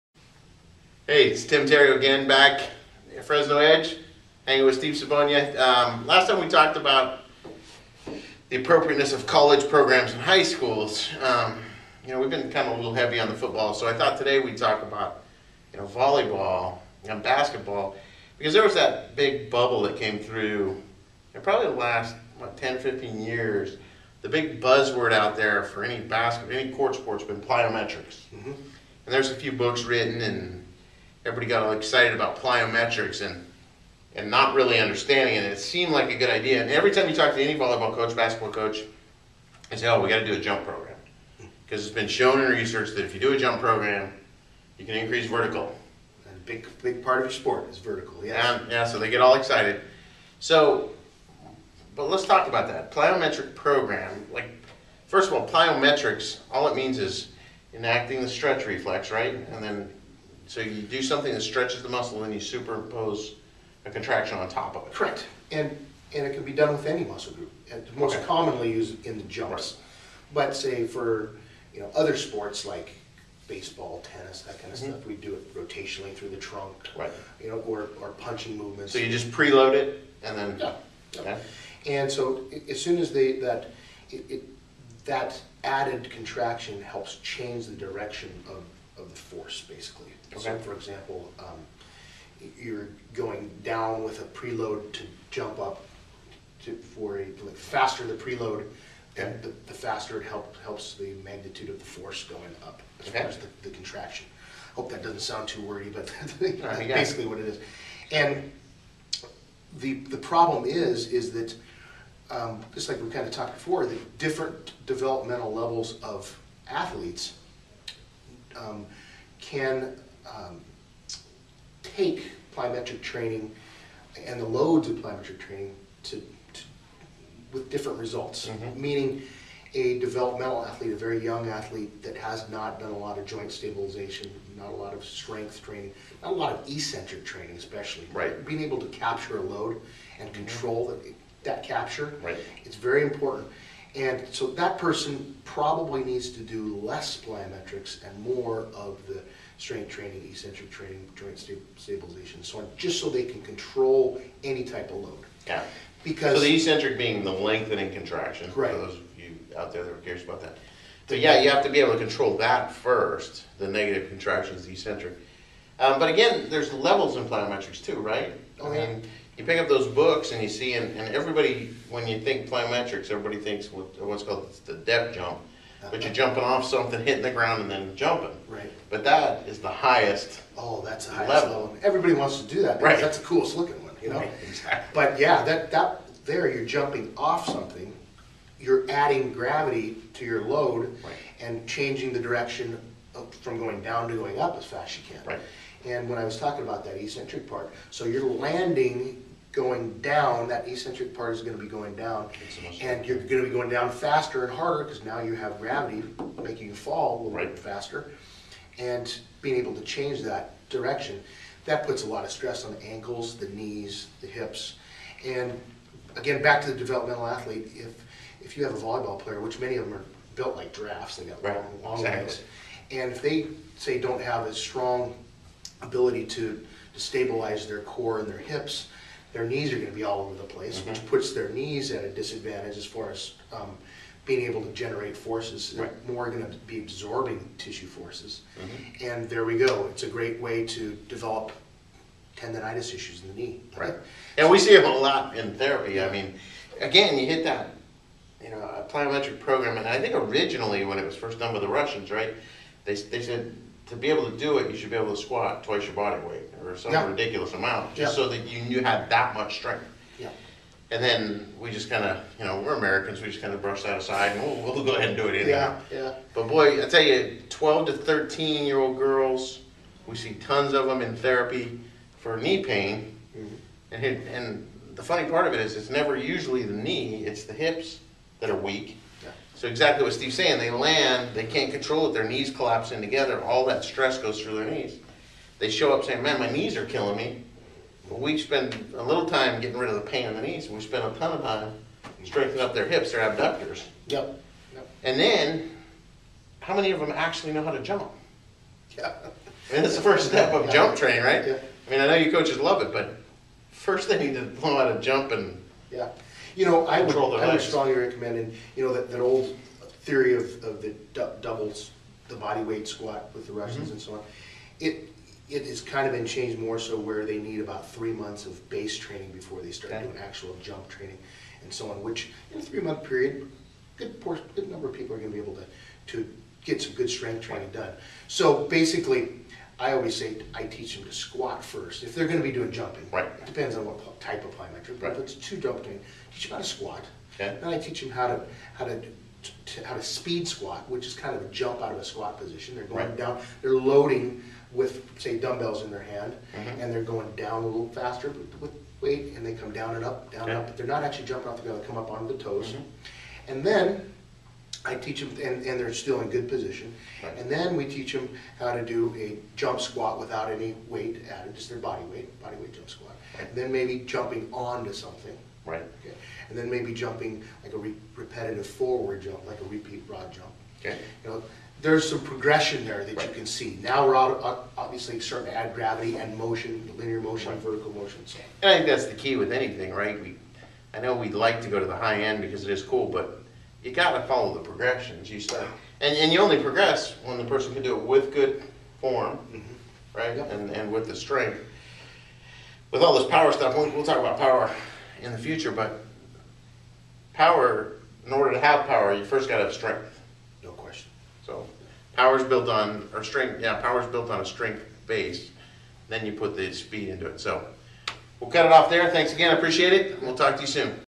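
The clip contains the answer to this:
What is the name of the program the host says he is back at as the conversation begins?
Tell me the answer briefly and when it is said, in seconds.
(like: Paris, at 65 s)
Fresno Edge, at 3 s.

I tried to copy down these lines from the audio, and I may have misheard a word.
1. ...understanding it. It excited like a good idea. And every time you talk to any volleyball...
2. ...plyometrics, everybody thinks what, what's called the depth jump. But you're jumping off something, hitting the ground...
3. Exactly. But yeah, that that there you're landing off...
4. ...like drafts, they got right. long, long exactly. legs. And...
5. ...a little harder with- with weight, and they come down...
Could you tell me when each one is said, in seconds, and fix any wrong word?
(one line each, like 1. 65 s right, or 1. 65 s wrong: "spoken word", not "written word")
1. 34 s wrong: "seemed", not "excited"
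2. 172 s right
3. 184 s wrong: "jumping", not "landing"
4. 220 s right
5. 347 s wrong: "faster", not "harder".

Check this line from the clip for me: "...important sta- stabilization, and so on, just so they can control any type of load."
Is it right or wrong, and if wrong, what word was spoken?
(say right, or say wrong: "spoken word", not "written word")
wrong: "joint", not "important".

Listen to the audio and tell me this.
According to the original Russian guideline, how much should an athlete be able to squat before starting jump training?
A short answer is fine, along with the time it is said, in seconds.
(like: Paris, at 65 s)
twice your body weight, at 255 s.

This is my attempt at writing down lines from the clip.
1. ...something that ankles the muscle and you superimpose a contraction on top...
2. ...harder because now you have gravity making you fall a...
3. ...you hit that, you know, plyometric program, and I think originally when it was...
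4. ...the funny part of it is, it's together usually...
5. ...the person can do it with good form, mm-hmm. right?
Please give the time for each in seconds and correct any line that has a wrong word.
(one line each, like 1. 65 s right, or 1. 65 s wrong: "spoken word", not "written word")
1. 61 s wrong: "stretches", not "ankles"
2. 204 s right
3. 247 s right
4. 274 s wrong: "never", not "together"
5. 387 s right.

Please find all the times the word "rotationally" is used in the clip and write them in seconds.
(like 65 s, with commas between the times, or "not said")
75 s.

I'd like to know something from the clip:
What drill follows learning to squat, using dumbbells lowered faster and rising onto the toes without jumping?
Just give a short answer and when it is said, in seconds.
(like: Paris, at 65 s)
speed squat, at 340 s.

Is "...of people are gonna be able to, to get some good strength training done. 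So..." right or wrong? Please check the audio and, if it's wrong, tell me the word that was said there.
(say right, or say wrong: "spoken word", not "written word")
right.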